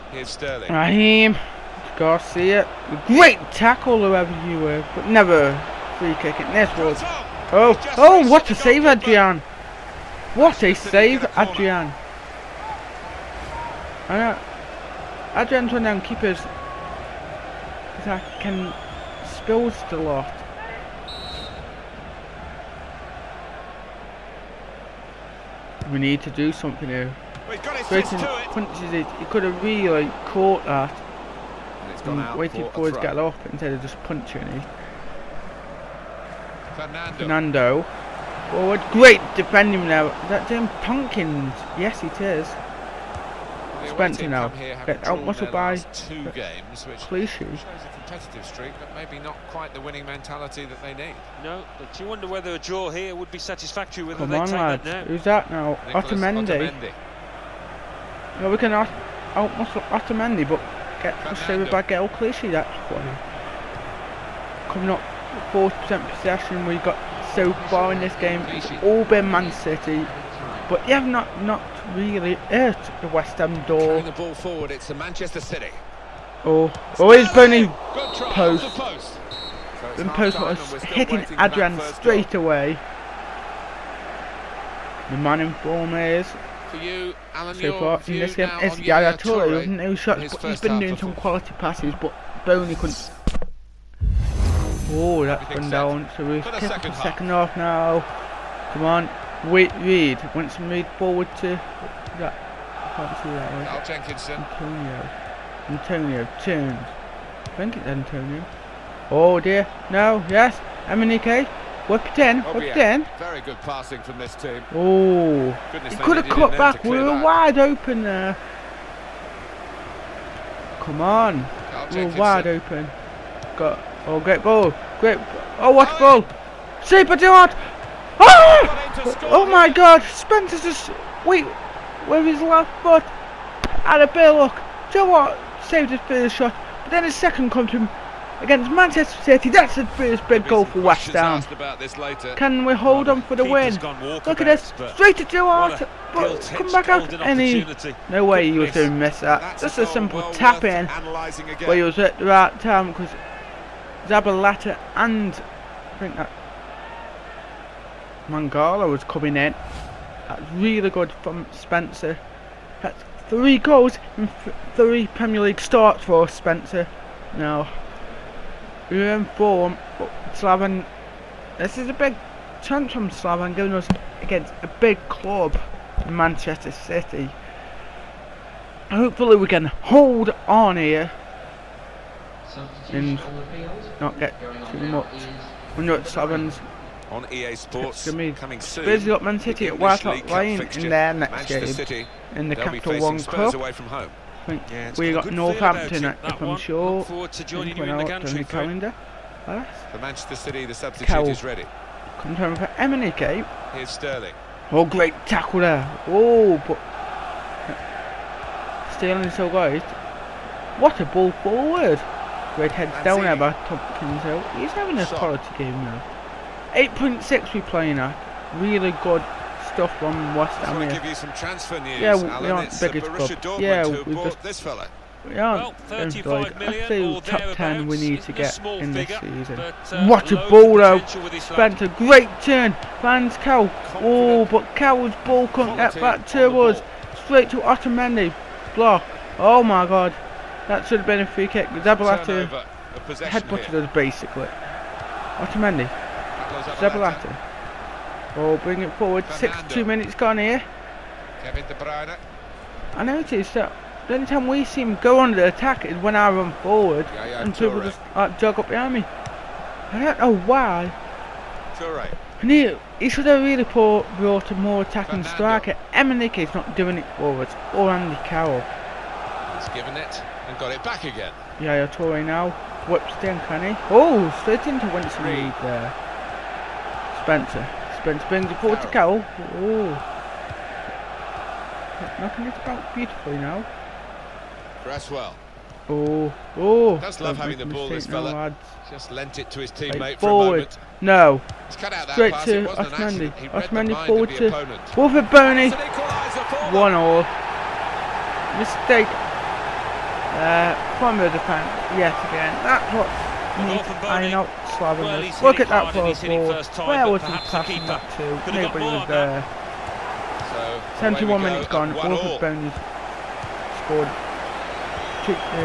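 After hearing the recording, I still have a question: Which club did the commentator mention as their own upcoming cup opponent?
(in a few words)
Northampton.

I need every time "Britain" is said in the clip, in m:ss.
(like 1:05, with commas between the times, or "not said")
0:27.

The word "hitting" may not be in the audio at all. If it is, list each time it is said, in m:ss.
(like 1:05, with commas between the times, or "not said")
1:20.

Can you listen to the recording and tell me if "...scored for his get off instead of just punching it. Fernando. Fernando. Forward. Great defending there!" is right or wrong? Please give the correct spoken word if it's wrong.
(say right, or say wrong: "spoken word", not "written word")
wrong: "waited", not "scored".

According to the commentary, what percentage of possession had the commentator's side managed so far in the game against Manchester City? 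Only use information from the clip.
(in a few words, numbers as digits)
40%.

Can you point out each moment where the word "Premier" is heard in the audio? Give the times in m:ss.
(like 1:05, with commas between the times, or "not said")
2:45.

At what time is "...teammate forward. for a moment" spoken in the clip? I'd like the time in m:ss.
4:49.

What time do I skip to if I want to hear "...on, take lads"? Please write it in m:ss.
0:54.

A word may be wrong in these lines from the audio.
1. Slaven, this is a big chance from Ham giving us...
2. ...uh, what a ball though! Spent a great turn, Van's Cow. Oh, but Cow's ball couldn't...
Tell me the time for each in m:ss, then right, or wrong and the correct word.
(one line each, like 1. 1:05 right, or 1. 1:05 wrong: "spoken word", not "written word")
1. 2:50 wrong: "Slaven", not "Ham"
2. 3:49 right.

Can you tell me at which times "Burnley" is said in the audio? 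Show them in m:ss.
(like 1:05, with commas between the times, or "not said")
1:17, 1:32.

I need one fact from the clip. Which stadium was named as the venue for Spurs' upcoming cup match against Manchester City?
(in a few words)
White Hart Lane.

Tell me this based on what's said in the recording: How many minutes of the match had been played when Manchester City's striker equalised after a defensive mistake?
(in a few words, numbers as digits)
71.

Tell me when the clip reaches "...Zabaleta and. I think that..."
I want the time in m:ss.
2:34.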